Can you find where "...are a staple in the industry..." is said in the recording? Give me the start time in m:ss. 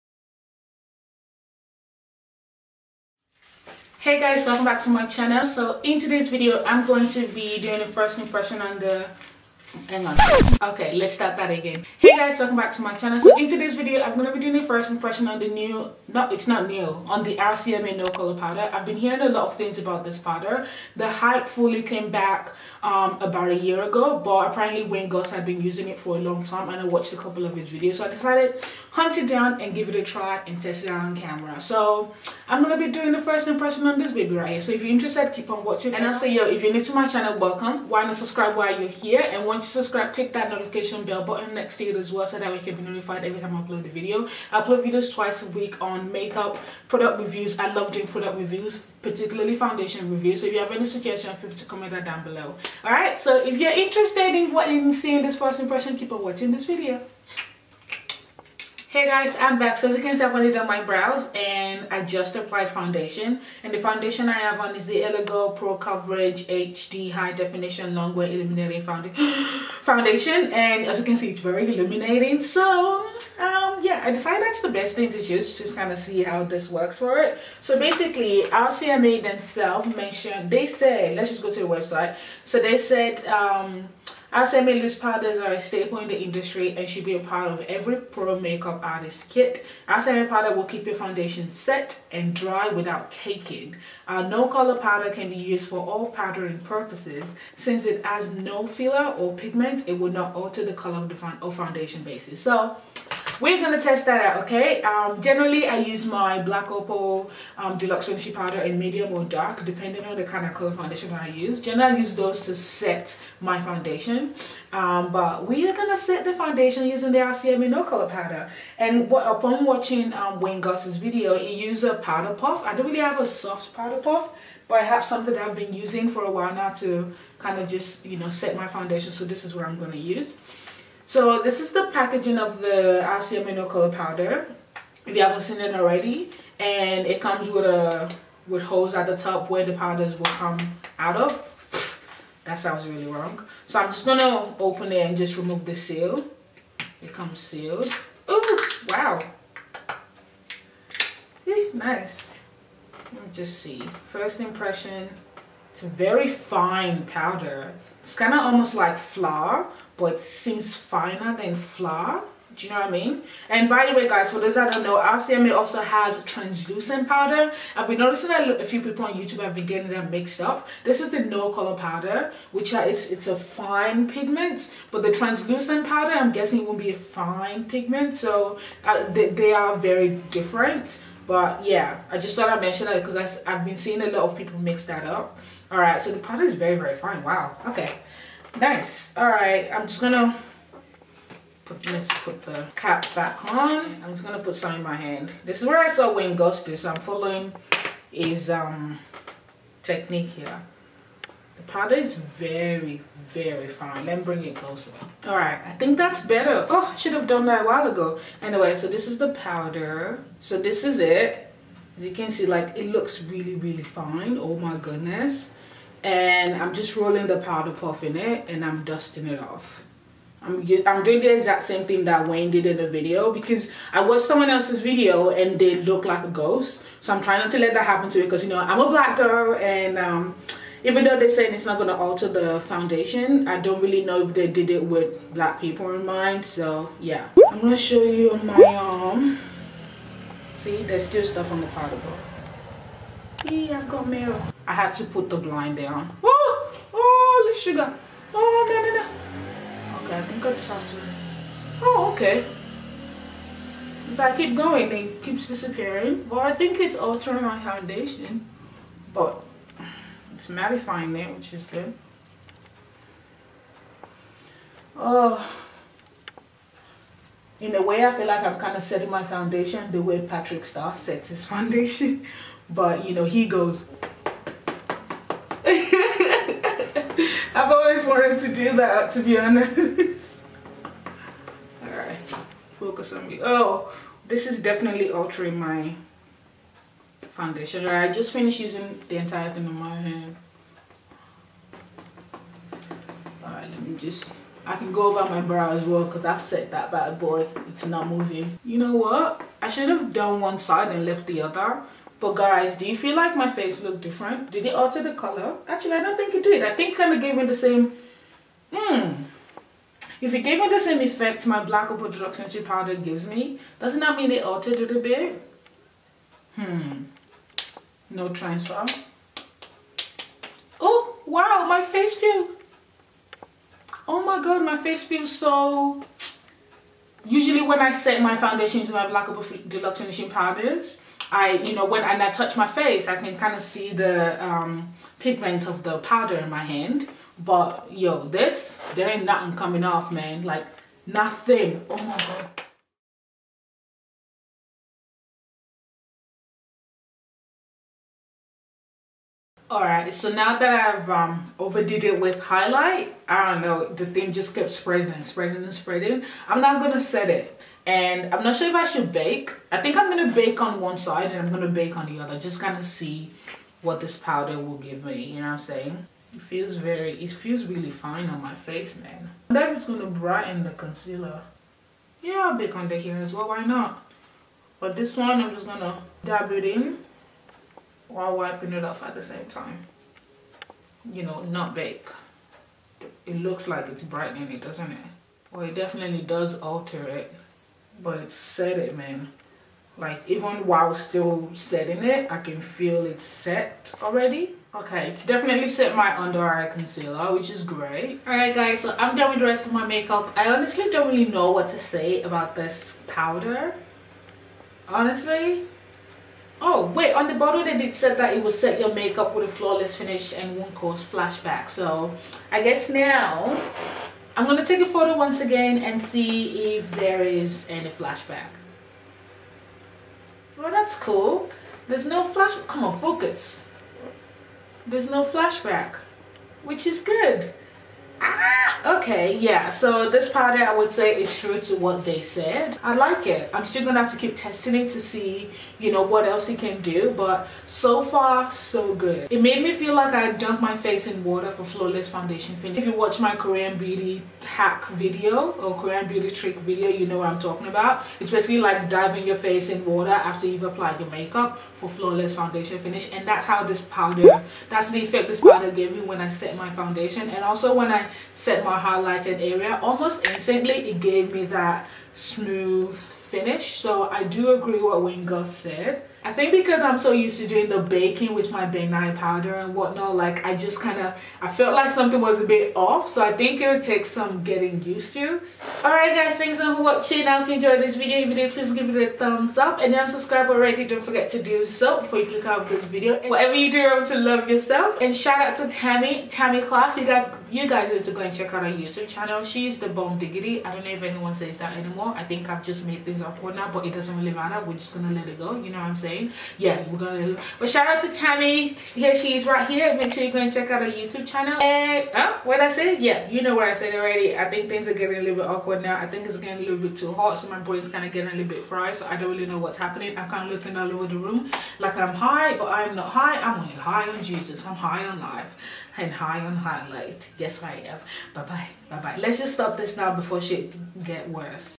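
1:25.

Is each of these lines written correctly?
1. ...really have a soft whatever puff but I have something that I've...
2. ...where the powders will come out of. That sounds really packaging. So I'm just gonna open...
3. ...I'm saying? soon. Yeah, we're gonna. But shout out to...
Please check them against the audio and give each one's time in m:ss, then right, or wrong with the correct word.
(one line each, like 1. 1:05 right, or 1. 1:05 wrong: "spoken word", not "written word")
1. 2:02 wrong: "powder", not "whatever"
2. 2:19 wrong: "wrong", not "packaging"
3. 8:15 right.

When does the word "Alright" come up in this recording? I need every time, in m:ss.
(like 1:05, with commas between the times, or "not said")
0:52, 4:41, 4:47, 4:53, 5:49, 6:38, 7:55.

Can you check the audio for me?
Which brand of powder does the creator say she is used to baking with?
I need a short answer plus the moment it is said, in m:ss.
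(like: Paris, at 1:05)
Ben Nye, at 7:48.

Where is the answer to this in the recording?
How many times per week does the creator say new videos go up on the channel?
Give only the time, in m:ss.
0:45.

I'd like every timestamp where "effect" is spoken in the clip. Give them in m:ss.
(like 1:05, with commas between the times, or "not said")
5:11, 7:35.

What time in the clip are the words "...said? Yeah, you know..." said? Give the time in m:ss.
8:22.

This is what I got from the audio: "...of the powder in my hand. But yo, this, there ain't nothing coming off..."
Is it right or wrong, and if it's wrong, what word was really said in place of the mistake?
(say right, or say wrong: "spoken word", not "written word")
right.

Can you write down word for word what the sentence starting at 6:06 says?
It feels very, it feels really fine on my face, man.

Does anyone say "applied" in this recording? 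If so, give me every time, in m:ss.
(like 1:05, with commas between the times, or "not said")
1:02, 7:30.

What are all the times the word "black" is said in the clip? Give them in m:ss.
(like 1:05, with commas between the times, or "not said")
1:46, 3:48, 3:55, 5:11, 5:29.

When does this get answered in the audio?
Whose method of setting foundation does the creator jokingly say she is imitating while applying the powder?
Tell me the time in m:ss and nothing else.
4:30.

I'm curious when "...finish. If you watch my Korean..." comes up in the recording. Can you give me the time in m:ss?
7:22.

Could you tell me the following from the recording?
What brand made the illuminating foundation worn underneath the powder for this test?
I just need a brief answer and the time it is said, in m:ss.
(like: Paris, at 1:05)
L.A. Girl, at 1:05.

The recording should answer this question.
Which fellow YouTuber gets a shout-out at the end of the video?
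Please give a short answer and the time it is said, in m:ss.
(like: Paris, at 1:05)
Tammy Clark, at 8:06.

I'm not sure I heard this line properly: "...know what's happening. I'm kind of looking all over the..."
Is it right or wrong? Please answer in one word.
right.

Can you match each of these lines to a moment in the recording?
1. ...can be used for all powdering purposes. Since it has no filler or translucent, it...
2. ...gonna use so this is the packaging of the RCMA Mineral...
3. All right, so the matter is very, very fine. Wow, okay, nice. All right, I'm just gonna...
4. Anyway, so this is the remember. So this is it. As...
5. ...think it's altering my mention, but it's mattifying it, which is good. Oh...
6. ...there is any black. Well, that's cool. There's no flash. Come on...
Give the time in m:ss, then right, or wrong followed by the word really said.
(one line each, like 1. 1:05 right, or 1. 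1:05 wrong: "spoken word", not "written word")
1. 1:35 wrong: "pigment", not "translucent"
2. 2:09 right
3. 3:05 wrong: "powder", not "matter"
4. 3:28 wrong: "powder", not "remember"
5. 4:16 wrong: "foundation", not "mention"
6. 6:56 wrong: "flashback", not "black".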